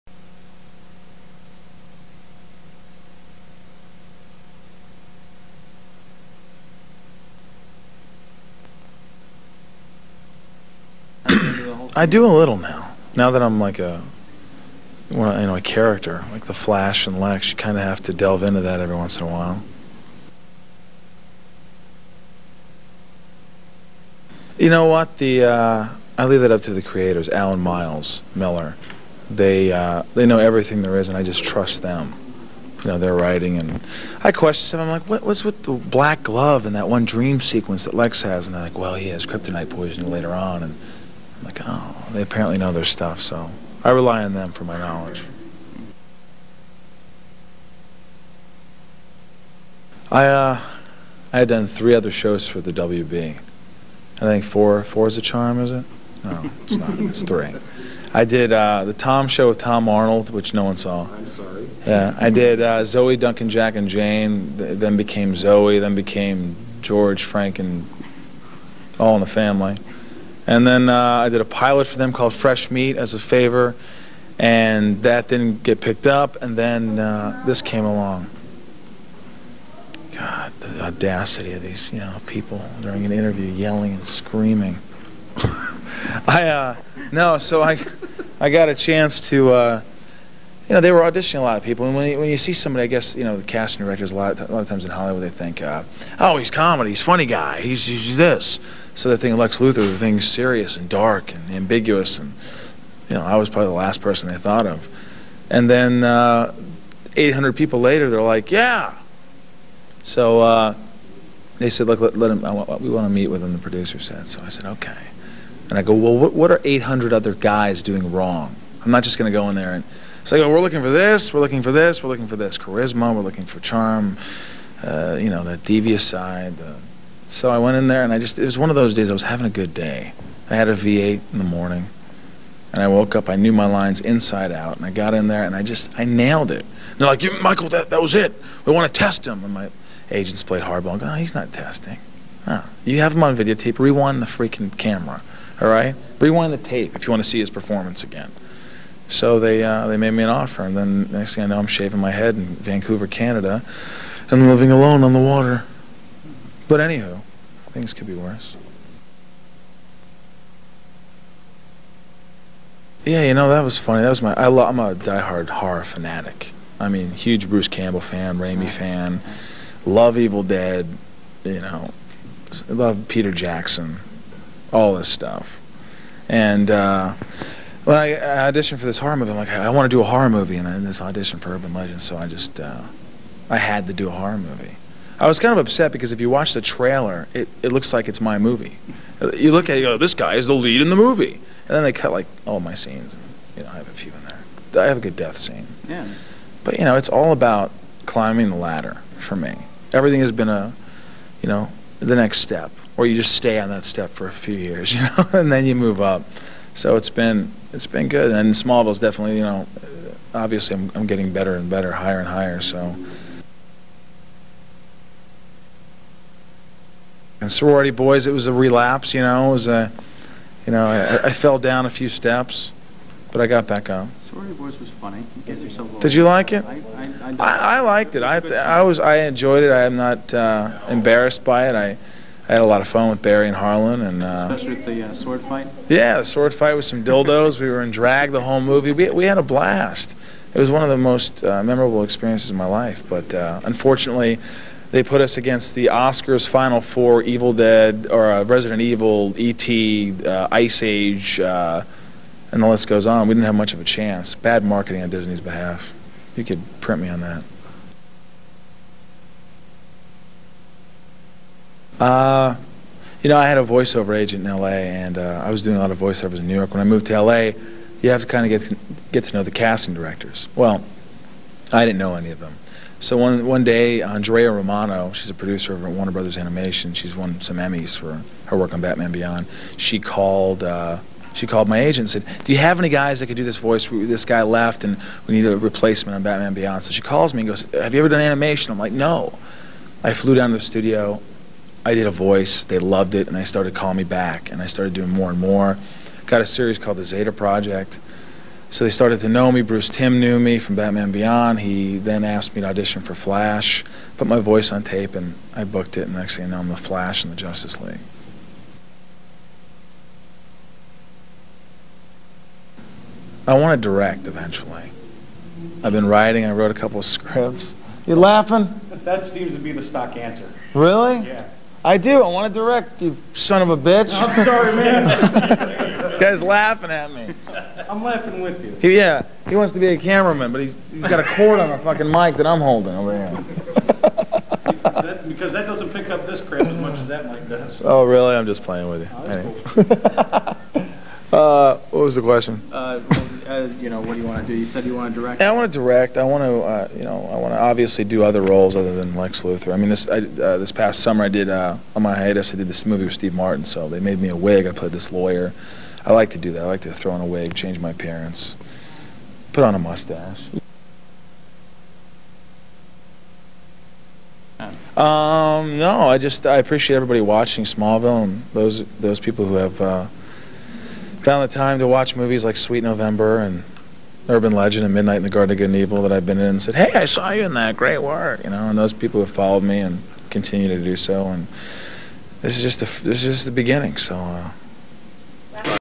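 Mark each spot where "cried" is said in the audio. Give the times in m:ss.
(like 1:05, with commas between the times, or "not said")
not said.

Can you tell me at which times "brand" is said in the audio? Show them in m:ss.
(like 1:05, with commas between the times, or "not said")
not said.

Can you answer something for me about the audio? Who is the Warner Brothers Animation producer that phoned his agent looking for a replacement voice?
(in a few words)
Andrea Romano.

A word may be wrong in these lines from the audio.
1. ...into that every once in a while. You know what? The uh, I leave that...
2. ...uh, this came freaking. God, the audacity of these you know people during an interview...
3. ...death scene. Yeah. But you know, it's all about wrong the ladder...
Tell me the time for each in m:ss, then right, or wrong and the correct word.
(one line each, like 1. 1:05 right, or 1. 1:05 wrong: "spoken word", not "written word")
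1. 0:18 right
2. 1:16 wrong: "along", not "freaking"
3. 3:15 wrong: "climbing", not "wrong".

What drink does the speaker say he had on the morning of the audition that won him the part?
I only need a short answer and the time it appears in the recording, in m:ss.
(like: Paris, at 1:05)
V8, at 2:10.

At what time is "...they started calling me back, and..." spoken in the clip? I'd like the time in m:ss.
4:53.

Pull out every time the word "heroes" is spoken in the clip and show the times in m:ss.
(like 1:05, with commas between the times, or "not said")
not said.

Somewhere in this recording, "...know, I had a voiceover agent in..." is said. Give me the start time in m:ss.
4:23.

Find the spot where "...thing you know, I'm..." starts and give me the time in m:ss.
5:06.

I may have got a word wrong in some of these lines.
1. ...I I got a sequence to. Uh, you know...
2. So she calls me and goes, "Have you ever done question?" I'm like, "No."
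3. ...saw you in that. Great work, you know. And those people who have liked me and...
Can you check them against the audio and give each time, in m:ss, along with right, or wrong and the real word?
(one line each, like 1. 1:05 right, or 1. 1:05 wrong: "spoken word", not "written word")
1. 1:27 wrong: "chance", not "sequence"
2. 4:46 wrong: "animation", not "question"
3. 6:17 wrong: "followed", not "liked".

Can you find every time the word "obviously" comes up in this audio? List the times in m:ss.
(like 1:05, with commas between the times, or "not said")
3:30, 5:47.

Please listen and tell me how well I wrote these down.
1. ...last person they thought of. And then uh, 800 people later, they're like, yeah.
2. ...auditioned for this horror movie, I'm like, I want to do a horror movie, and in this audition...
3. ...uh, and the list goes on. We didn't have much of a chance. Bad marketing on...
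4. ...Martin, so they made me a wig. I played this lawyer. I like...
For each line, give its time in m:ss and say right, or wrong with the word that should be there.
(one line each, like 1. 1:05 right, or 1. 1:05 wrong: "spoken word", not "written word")
1. 1:43 right
2. 2:58 right
3. 4:11 right
4. 5:53 right.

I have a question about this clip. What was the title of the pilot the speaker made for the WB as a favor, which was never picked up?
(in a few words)
Fresh Meat.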